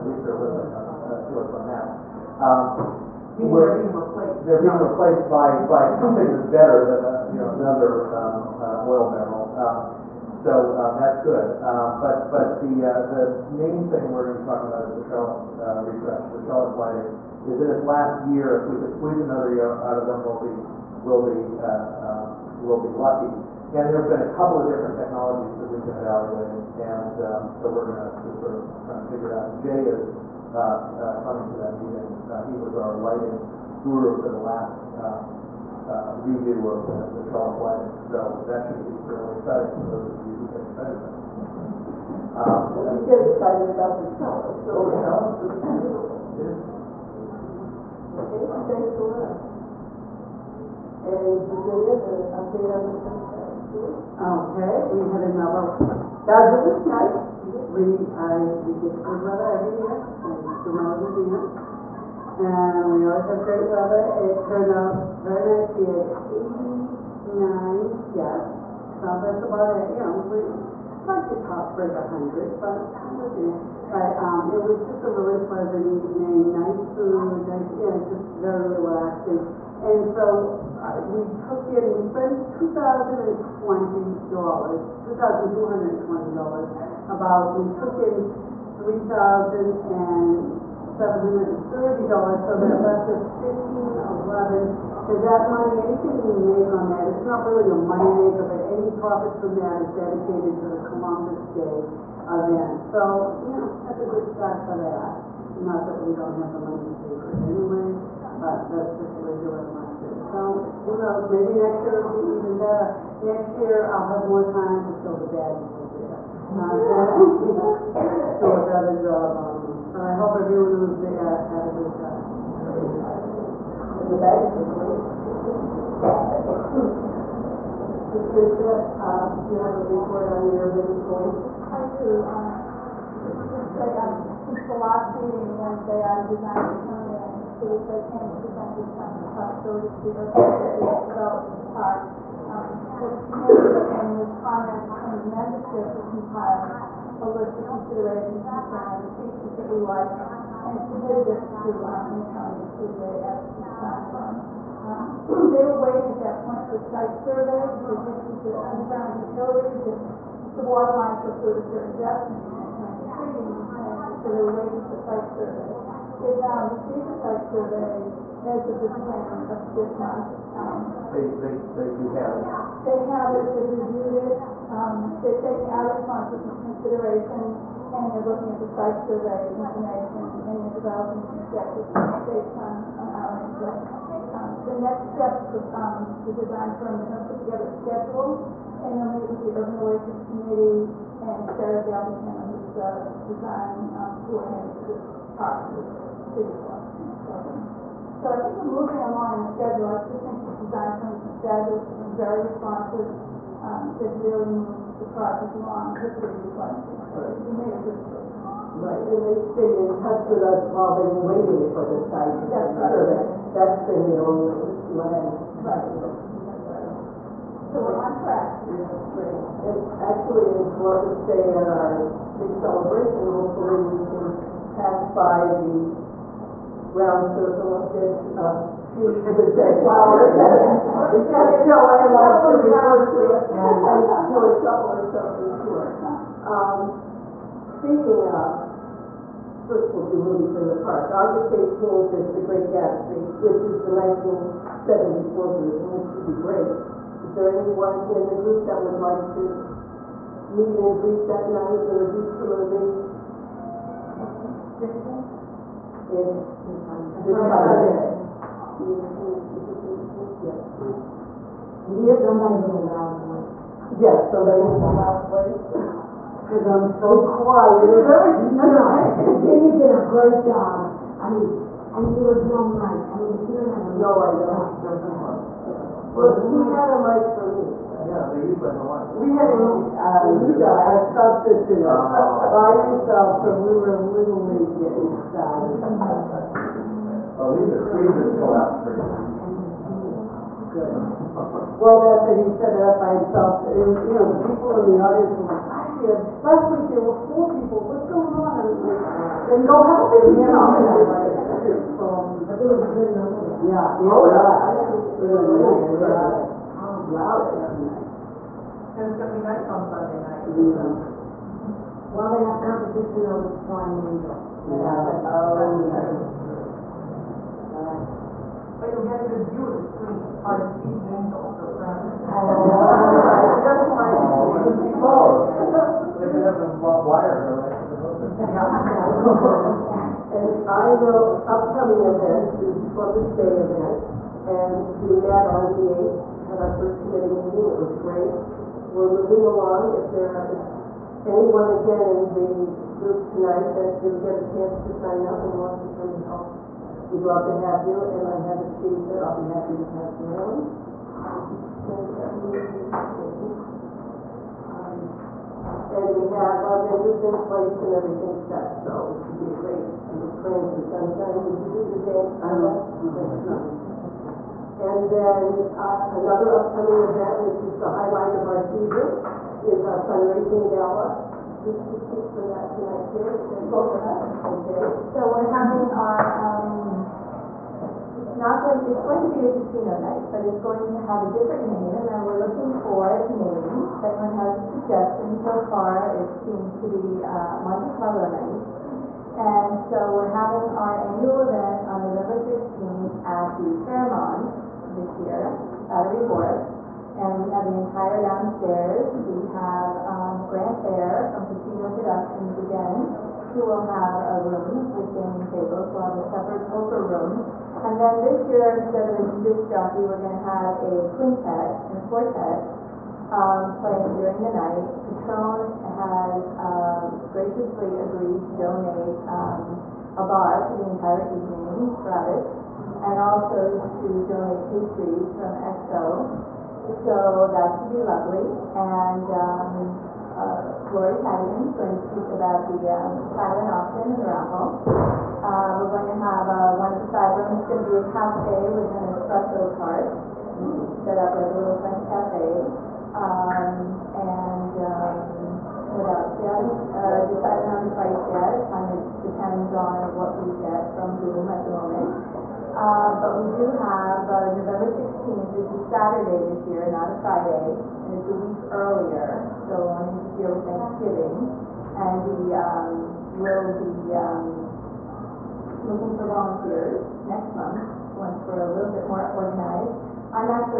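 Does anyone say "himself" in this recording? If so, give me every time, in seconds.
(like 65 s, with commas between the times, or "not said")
282 s, 293 s.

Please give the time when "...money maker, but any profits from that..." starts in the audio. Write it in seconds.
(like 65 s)
97 s.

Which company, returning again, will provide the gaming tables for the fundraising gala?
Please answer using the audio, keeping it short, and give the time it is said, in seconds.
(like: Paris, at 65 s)
Casino Productions, at 401 s.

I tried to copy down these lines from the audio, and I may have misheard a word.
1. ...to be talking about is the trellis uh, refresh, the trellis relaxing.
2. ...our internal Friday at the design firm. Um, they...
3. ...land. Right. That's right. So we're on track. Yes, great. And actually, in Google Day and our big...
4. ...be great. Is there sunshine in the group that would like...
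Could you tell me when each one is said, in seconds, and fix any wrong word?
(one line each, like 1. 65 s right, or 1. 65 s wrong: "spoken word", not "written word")
1. 14 s wrong: "lighting", not "relaxing"
2. 151 s wrong: "Fluid", not "Friday"
3. 214 s wrong: "Columbus", not "Google"
4. 246 s wrong: "anyone", not "sunshine".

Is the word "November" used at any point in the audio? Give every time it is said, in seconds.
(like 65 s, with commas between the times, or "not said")
392 s, 454 s.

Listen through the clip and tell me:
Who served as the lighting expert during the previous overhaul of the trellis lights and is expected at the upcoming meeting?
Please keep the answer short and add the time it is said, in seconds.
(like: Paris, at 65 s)
Jay, at 29 s.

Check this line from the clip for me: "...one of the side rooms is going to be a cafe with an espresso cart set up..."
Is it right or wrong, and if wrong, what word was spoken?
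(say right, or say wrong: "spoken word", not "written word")
right.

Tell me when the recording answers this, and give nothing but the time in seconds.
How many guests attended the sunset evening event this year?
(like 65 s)
66 s.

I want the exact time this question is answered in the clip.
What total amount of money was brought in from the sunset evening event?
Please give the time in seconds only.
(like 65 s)
88 s.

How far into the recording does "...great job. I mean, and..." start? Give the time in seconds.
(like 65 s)
270 s.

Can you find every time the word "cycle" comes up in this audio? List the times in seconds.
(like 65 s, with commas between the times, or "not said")
not said.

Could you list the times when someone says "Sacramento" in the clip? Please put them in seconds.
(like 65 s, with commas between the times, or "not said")
not said.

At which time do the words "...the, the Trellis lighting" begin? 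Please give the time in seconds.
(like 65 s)
36 s.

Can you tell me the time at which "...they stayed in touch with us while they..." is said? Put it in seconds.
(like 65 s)
209 s.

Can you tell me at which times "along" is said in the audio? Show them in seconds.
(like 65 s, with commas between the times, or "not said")
199 s, 205 s, 339 s.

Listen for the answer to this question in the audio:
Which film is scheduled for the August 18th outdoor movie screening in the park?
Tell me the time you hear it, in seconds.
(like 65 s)
242 s.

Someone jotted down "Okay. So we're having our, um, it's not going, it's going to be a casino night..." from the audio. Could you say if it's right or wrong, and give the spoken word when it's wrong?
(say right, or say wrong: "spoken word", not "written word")
right.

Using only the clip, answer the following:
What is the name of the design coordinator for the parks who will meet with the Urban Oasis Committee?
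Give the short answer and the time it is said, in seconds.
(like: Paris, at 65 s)
Sherry Galveston, at 191 s.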